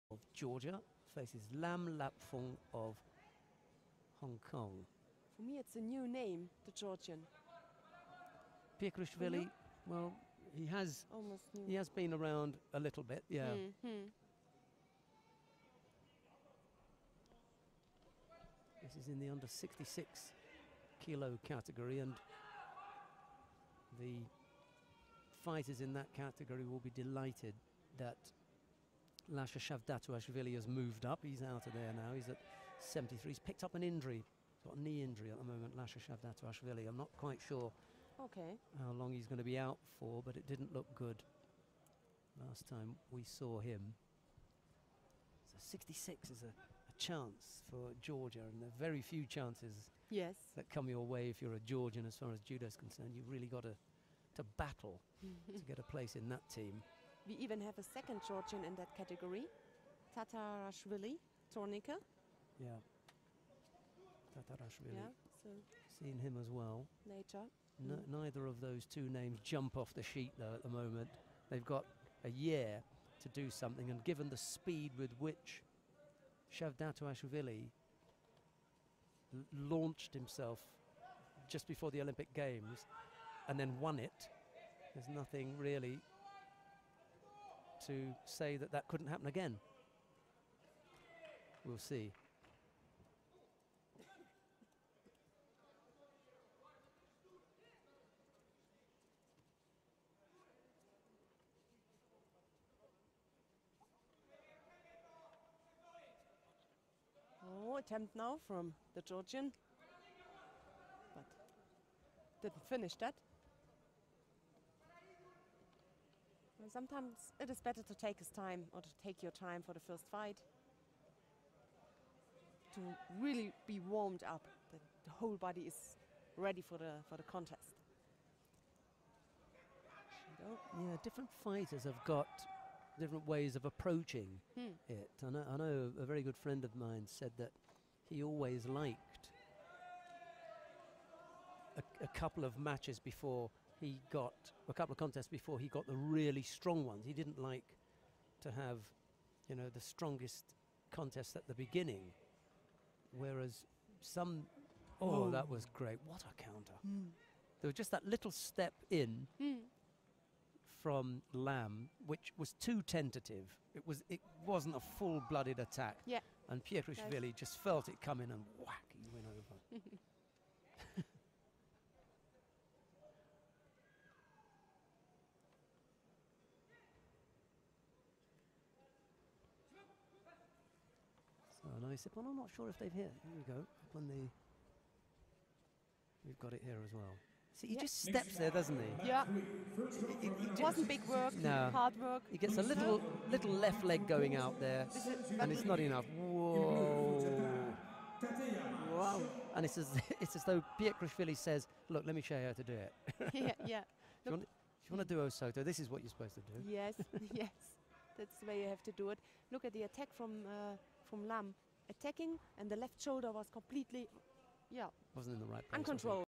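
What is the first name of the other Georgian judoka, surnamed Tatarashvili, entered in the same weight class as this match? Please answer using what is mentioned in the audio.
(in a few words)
Tornika.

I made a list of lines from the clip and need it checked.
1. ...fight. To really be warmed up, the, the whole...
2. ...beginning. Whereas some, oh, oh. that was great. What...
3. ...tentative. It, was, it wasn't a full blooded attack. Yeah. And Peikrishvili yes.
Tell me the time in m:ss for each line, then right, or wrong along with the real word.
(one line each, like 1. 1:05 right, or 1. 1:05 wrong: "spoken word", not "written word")
1. 2:00 right
2. 2:31 right
3. 2:42 right.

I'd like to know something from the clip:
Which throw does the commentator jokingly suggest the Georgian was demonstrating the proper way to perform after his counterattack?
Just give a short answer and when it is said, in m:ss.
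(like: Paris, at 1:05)
Osoto, at 3:25.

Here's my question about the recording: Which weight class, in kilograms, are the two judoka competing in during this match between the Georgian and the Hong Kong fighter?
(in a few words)
66 kg.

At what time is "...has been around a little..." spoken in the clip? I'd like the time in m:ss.
0:11.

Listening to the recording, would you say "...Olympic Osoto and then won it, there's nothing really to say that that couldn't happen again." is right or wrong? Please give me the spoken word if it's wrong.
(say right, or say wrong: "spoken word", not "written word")
wrong: "Games", not "Osoto".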